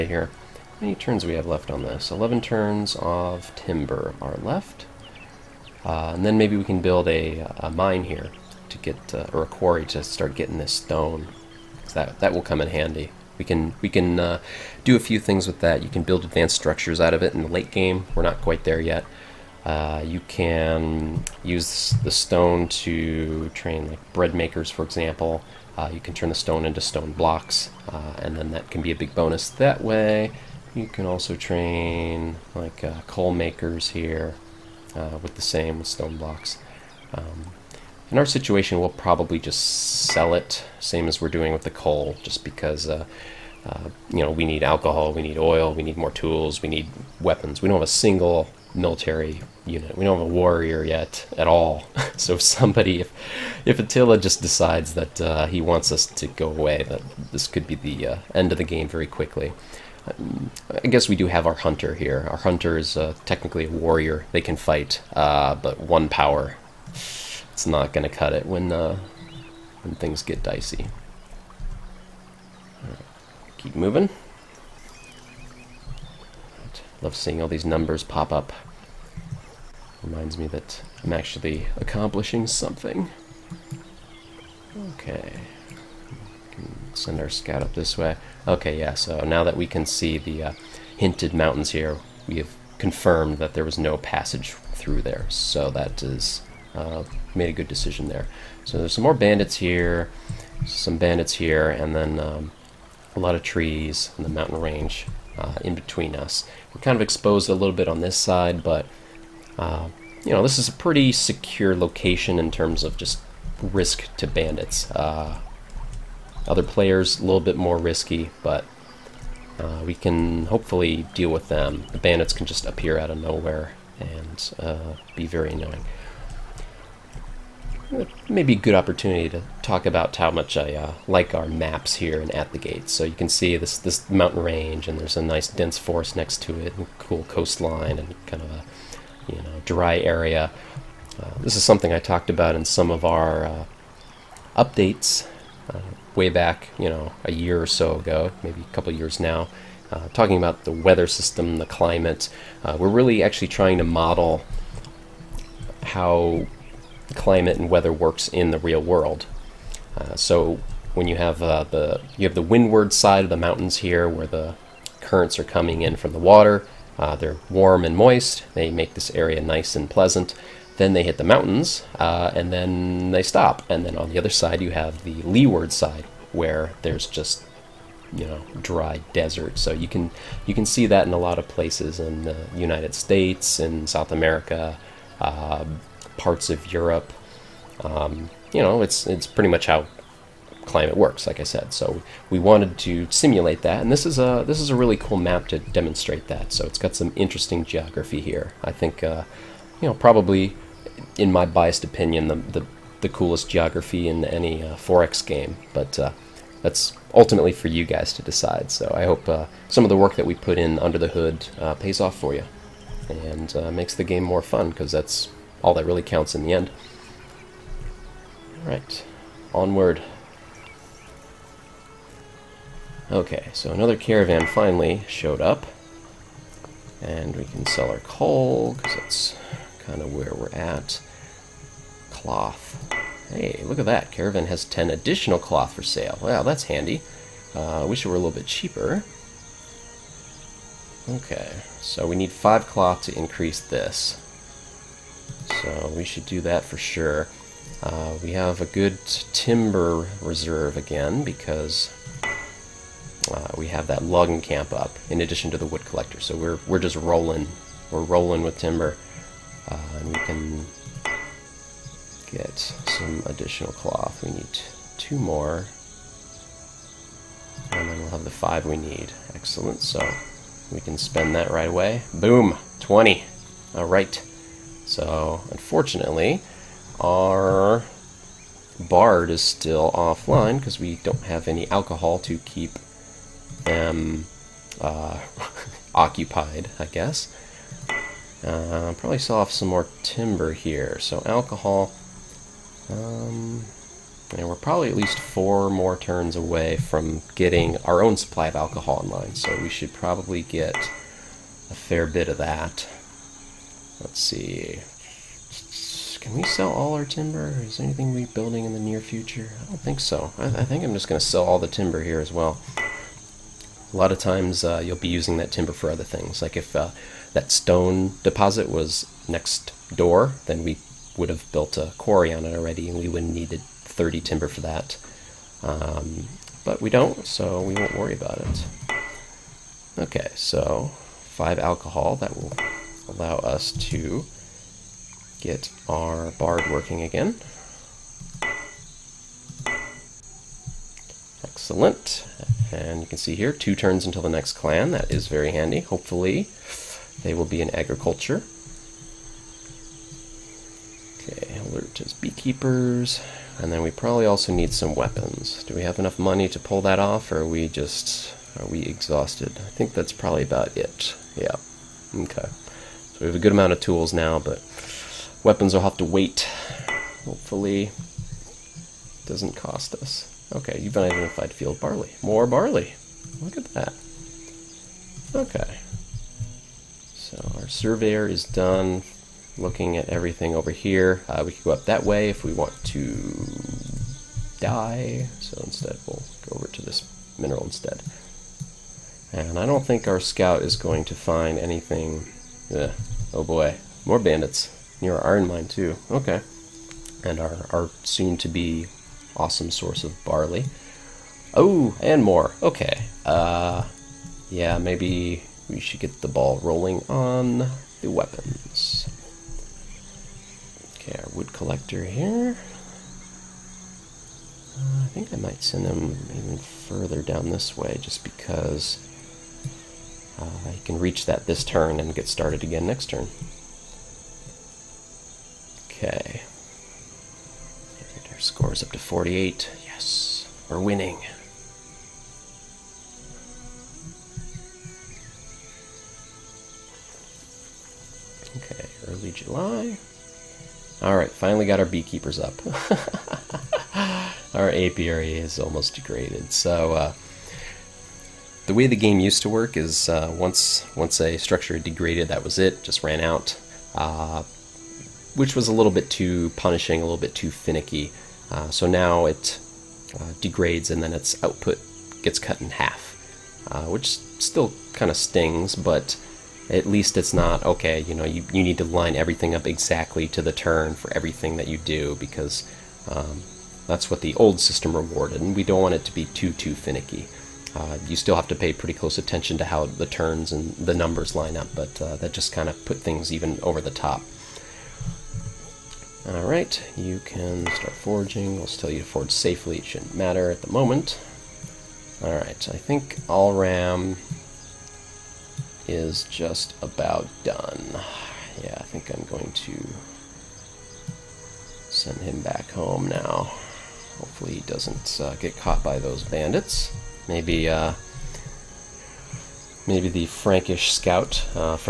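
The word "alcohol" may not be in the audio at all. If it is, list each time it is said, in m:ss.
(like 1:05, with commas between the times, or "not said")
0:44, 4:41, 4:51, 4:58, 5:31.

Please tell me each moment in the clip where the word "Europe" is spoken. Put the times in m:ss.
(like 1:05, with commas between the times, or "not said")
3:06.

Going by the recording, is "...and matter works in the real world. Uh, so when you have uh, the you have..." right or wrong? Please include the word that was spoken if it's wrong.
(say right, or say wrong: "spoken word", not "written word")
wrong: "weather", not "matter".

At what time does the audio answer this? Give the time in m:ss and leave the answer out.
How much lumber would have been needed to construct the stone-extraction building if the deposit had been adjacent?
5:23.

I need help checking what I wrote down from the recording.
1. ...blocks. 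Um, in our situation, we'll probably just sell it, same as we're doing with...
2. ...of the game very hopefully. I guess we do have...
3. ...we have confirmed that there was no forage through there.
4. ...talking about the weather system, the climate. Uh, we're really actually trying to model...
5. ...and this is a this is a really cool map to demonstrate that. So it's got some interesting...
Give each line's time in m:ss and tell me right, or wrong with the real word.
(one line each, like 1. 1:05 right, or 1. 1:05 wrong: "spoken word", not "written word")
1. 0:36 right
2. 0:58 wrong: "quickly", not "hopefully"
3. 1:32 wrong: "passage", not "forage"
4. 2:30 right
5. 3:13 right.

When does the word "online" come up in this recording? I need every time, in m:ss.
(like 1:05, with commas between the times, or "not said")
4:59.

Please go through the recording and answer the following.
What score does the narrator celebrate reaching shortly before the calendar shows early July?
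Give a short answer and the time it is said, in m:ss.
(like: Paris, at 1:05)
48, at 7:08.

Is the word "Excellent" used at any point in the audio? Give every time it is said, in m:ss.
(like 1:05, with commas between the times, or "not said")
4:29, 5:41.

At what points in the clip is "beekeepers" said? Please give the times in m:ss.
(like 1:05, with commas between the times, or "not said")
5:52, 7:21.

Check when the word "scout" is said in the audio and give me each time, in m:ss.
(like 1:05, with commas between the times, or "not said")
1:27, 6:30, 8:30.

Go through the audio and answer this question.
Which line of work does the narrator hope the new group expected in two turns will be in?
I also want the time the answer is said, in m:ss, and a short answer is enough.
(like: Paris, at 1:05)
agriculture, at 5:47.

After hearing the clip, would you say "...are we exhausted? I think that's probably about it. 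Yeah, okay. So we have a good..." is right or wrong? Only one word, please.
right.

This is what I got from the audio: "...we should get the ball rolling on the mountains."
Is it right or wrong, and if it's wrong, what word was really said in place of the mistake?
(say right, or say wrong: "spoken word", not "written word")
wrong: "weapons", not "mountains".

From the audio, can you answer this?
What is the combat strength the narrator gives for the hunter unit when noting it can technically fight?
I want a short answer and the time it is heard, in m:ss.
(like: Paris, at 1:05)
1, at 1:05.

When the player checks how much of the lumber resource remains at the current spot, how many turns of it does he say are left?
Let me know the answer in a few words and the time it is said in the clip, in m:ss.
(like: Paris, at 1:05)
11, at 0:02.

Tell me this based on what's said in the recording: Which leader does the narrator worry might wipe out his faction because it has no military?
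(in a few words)
Attila.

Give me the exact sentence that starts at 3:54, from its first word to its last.
Caravan has 10 additional cloth for sale.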